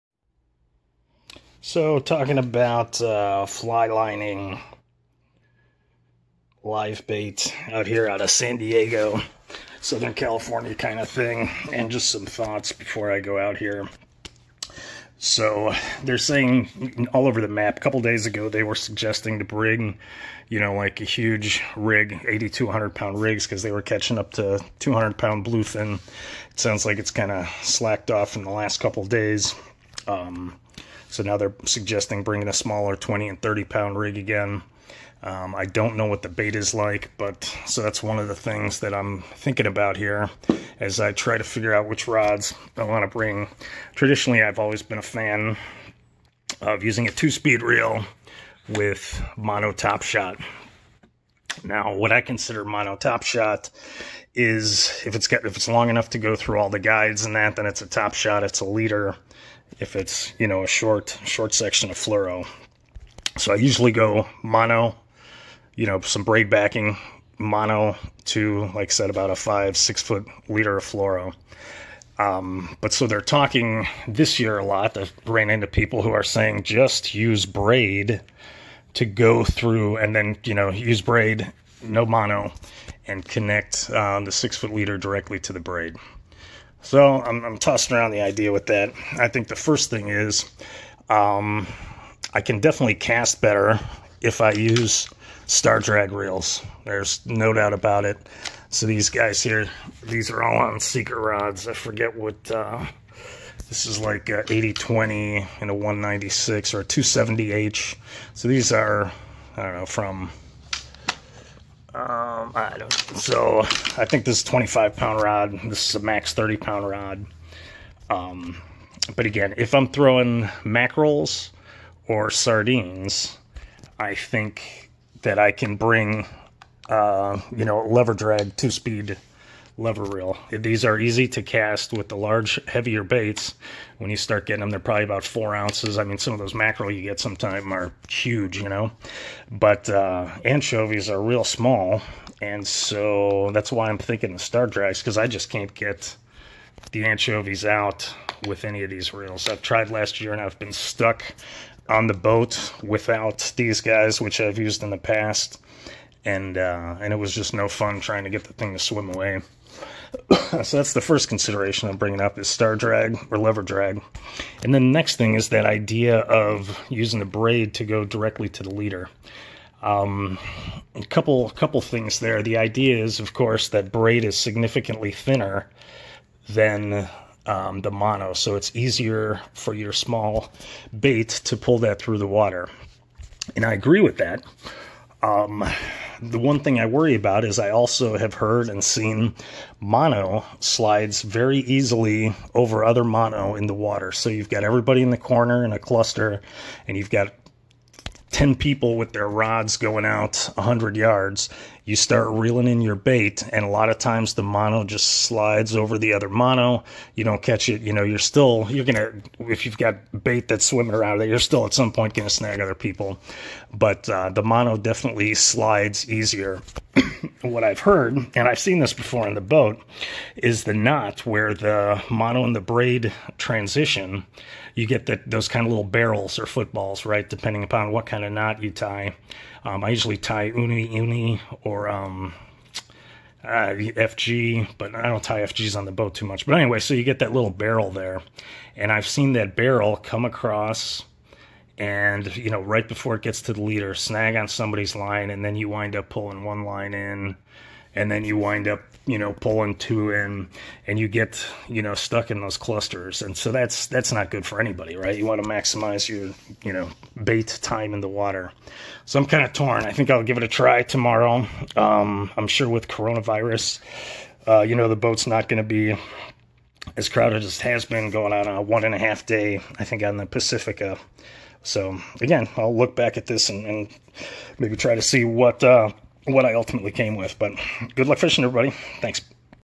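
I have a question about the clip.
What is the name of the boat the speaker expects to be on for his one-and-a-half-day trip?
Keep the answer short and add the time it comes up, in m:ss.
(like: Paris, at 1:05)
Pacifica, at 4:30.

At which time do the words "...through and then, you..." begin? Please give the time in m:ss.
1:19.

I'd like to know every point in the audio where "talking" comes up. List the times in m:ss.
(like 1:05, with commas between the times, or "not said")
0:01, 1:13.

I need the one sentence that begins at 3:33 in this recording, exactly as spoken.
But uh, the mono definitely slides easier.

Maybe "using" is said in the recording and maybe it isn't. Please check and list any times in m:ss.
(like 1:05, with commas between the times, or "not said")
0:46, 2:46.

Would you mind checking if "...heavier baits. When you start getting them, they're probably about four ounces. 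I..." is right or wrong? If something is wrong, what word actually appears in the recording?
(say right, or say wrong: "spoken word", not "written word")
right.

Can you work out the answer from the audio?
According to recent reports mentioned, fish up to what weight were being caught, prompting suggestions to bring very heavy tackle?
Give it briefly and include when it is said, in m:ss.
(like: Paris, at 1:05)
200 pounds, at 0:24.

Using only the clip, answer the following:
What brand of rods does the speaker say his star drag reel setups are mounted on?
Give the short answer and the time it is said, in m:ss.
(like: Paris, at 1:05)
Seeker, at 1:40.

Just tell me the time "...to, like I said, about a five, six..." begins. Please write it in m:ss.
1:08.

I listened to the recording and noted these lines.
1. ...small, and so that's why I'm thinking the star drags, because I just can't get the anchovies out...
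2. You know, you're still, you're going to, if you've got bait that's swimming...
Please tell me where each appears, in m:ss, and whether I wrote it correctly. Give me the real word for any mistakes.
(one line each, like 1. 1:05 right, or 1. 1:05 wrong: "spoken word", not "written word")
1. 2:21 right
2. 3:27 right.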